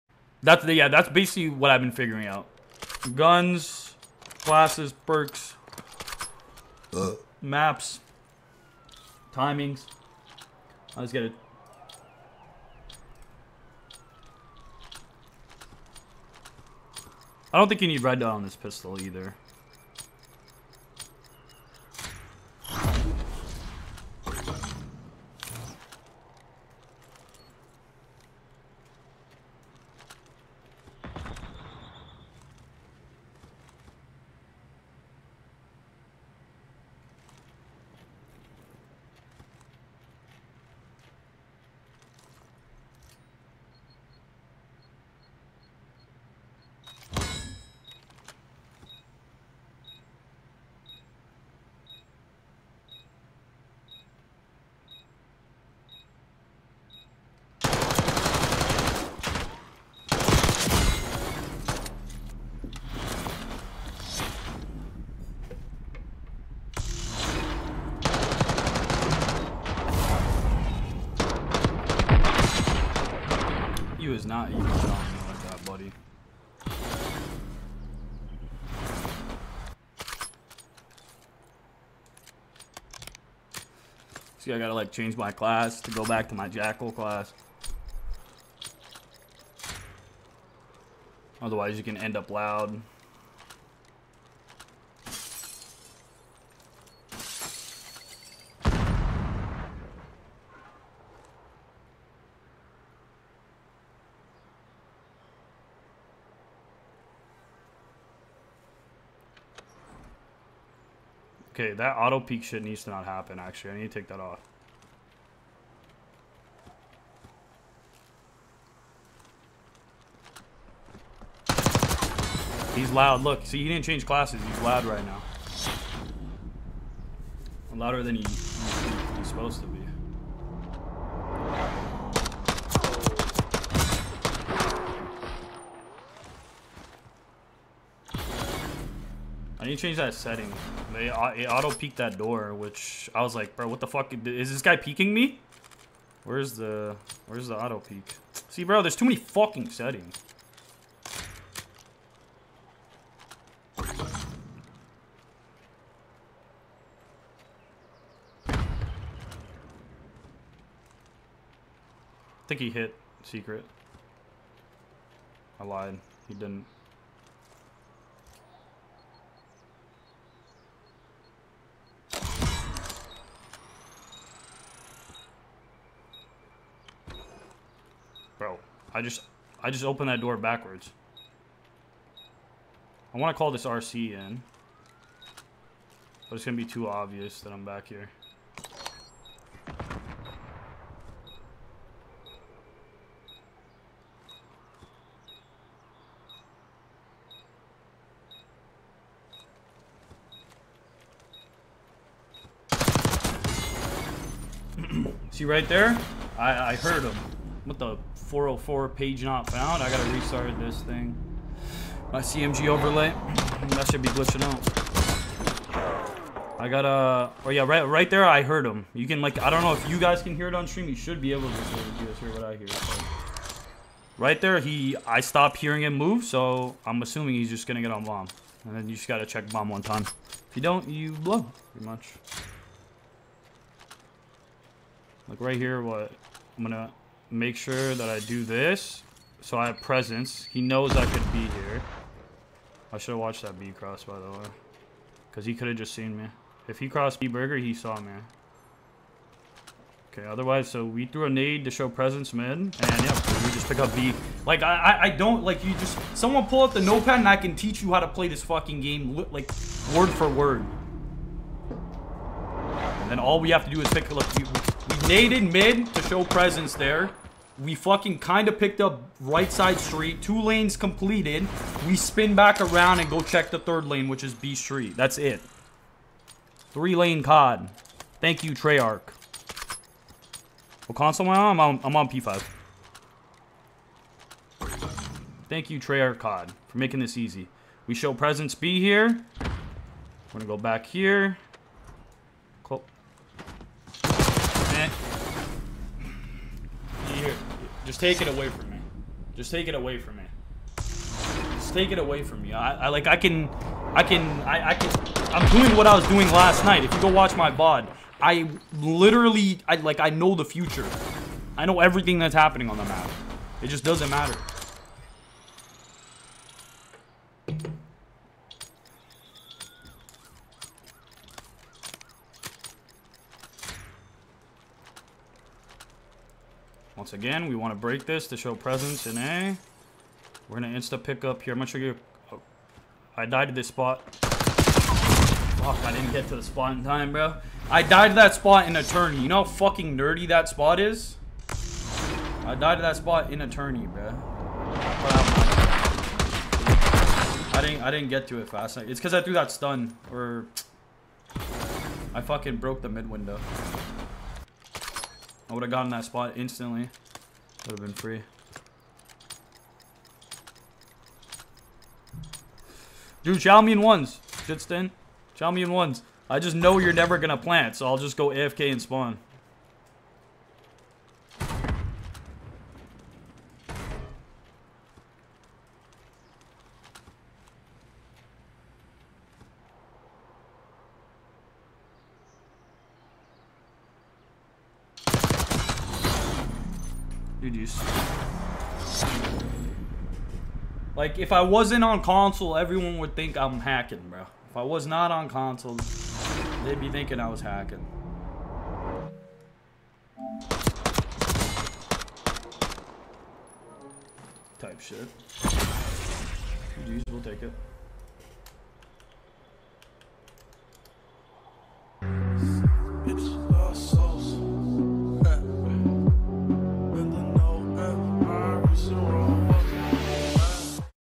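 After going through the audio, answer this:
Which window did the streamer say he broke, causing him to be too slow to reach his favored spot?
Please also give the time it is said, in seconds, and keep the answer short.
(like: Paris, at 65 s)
the mid window, at 352 s.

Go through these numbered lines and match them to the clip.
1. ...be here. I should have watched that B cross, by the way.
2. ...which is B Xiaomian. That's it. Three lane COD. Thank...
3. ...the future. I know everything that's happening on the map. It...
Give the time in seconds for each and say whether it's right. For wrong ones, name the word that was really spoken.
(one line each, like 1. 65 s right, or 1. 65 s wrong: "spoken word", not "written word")
1. 241 s right
2. 274 s wrong: "Street", not "Xiaomian"
3. 310 s right.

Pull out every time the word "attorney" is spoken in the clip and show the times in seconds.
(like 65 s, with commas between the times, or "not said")
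338 s, 343 s.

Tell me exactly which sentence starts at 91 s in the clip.
Otherwise you can end up loud.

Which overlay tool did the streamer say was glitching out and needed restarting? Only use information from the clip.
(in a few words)
CMG overlay.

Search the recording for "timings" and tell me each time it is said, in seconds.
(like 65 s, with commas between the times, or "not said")
9 s.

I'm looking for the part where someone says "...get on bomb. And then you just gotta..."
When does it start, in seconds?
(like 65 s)
227 s.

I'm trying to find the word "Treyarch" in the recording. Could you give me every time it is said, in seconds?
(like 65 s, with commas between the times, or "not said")
278 s, 285 s.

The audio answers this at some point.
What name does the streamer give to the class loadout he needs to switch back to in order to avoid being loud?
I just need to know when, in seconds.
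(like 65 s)
86 s.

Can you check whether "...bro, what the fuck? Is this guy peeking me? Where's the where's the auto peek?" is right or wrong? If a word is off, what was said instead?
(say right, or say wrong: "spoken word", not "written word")
right.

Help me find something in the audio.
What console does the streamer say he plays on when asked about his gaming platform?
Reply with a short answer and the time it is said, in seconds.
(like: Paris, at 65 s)
P5, at 282 s.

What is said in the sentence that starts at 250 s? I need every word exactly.
Okay, otherwise, so we threw a nade to show presence mid, and yeah, we just pick up B.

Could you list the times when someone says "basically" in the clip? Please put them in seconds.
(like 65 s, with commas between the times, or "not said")
1 s.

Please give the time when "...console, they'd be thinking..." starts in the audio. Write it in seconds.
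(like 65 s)
395 s.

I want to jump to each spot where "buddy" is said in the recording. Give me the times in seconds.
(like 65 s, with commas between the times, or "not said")
75 s.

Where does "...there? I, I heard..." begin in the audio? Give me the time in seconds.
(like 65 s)
205 s.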